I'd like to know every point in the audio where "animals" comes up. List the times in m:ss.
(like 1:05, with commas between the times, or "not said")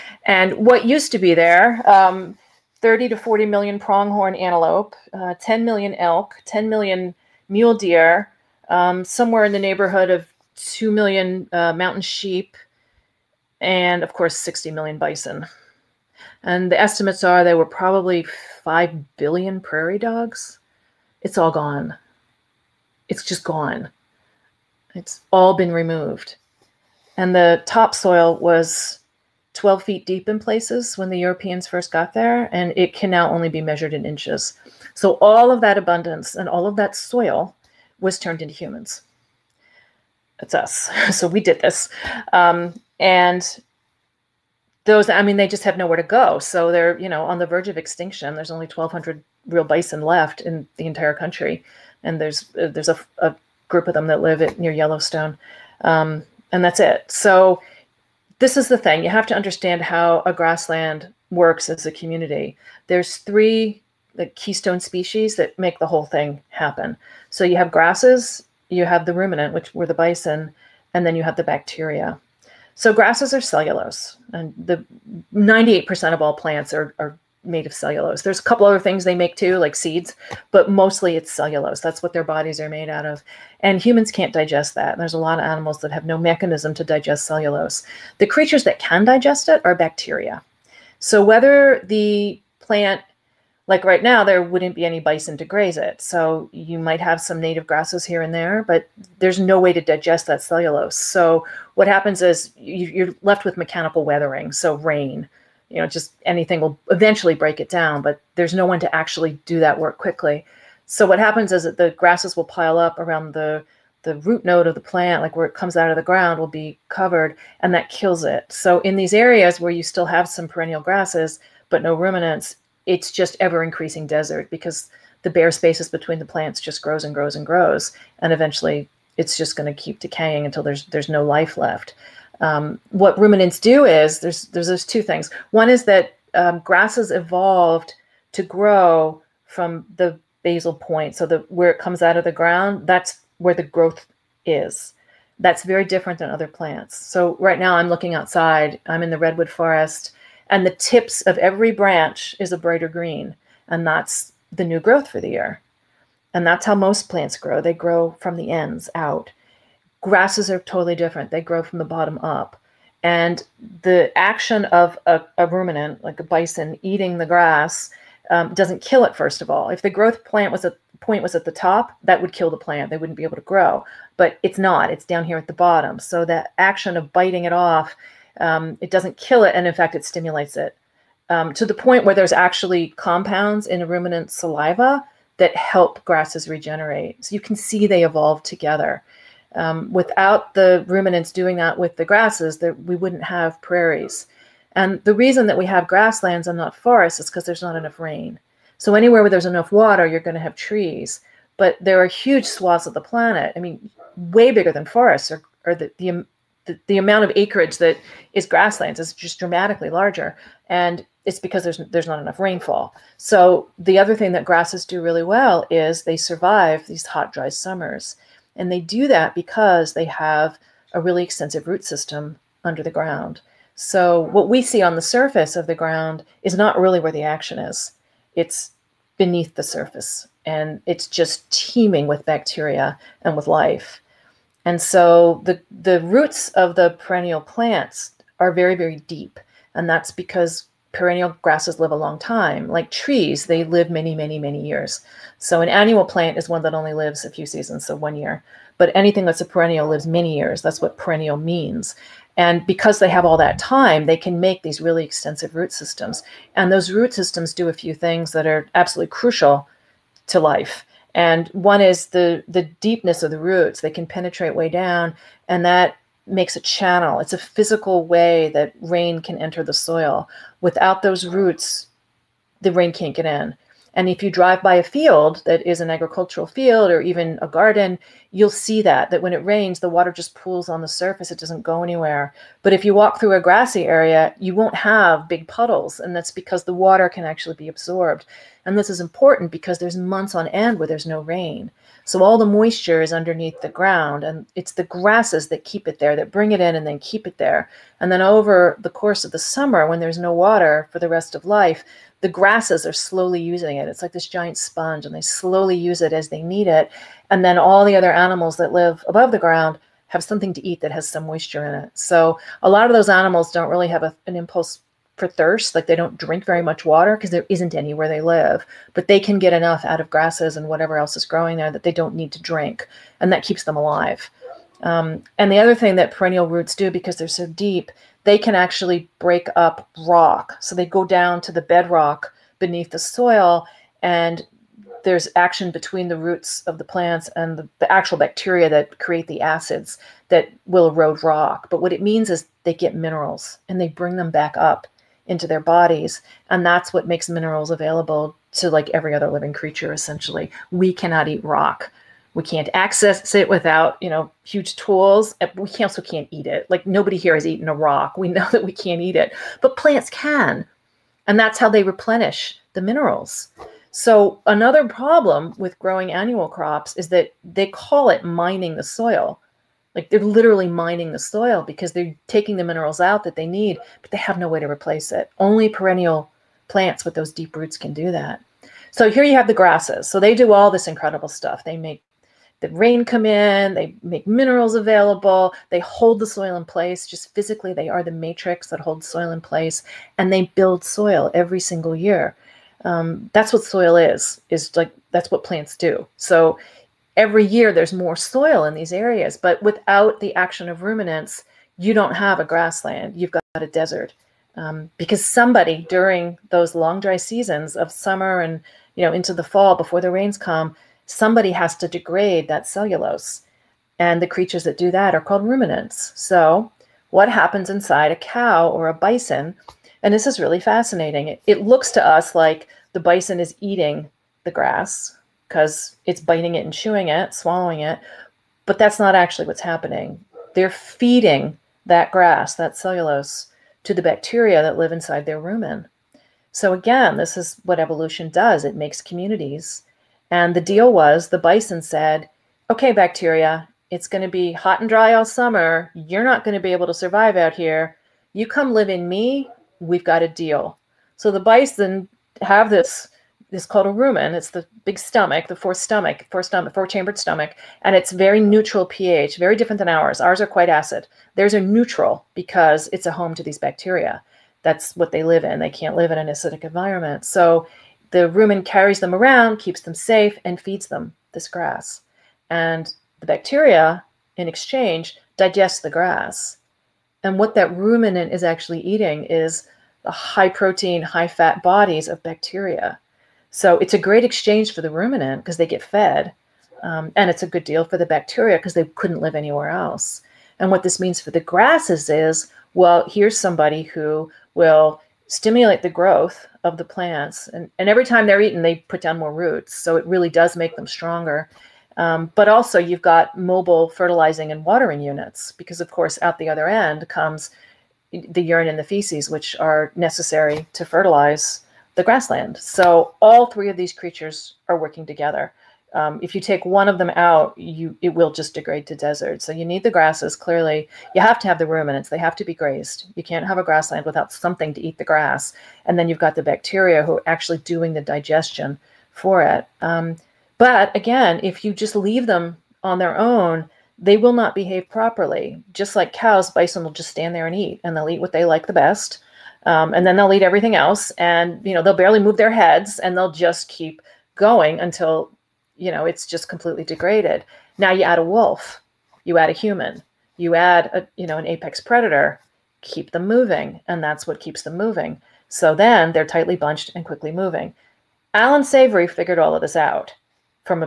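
1:25, 5:08, 5:13.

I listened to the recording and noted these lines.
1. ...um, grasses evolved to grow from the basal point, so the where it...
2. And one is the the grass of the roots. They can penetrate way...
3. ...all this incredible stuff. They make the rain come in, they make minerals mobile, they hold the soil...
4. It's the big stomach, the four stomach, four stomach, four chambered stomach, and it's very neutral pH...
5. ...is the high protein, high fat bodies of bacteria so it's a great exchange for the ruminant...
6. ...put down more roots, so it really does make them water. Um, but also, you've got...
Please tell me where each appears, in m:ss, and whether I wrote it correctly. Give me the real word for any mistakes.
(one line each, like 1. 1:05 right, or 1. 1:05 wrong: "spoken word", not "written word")
1. 2:16 right
2. 4:21 wrong: "deepness", not "grass"
3. 6:20 wrong: "available", not "mobile"
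4. 7:34 right
5. 7:59 right
6. 8:18 wrong: "stronger", not "water".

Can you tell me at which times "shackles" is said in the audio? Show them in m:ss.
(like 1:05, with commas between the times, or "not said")
not said.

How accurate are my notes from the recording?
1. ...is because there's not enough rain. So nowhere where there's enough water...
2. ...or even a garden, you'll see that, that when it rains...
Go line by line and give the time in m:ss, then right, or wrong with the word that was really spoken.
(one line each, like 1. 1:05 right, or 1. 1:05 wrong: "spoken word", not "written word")
1. 3:17 wrong: "anywhere", not "nowhere"
2. 4:36 right.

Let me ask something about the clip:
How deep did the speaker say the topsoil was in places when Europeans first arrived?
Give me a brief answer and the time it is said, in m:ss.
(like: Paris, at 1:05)
12 feet, at 0:29.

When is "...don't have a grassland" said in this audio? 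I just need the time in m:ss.
6:41.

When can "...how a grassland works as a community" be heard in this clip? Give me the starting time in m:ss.
0:59.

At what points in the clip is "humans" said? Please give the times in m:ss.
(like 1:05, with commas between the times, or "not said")
0:38, 1:23, 9:09.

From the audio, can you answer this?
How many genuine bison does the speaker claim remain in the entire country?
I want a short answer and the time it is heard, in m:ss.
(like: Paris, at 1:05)
1,200, at 0:48.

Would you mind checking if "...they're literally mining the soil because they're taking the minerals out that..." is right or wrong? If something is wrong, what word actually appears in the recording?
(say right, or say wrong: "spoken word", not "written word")
right.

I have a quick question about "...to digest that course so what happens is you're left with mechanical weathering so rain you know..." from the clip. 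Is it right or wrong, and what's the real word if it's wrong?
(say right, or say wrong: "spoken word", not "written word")
wrong: "cellulose", not "course".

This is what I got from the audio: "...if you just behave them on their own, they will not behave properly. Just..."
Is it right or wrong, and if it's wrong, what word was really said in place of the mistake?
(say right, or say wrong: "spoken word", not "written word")
wrong: "leave", not "behave".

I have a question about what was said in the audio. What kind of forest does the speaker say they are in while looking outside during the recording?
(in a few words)
redwood forest.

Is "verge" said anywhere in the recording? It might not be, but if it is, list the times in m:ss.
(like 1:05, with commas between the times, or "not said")
0:47.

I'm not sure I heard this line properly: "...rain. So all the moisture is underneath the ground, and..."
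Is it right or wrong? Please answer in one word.
right.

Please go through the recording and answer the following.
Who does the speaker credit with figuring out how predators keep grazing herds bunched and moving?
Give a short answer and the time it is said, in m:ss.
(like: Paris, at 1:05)
Alan Savory, at 9:18.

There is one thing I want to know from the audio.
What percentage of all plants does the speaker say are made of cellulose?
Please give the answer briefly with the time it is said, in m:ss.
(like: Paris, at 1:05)
98%, at 1:15.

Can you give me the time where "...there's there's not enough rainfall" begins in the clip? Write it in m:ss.
3:31.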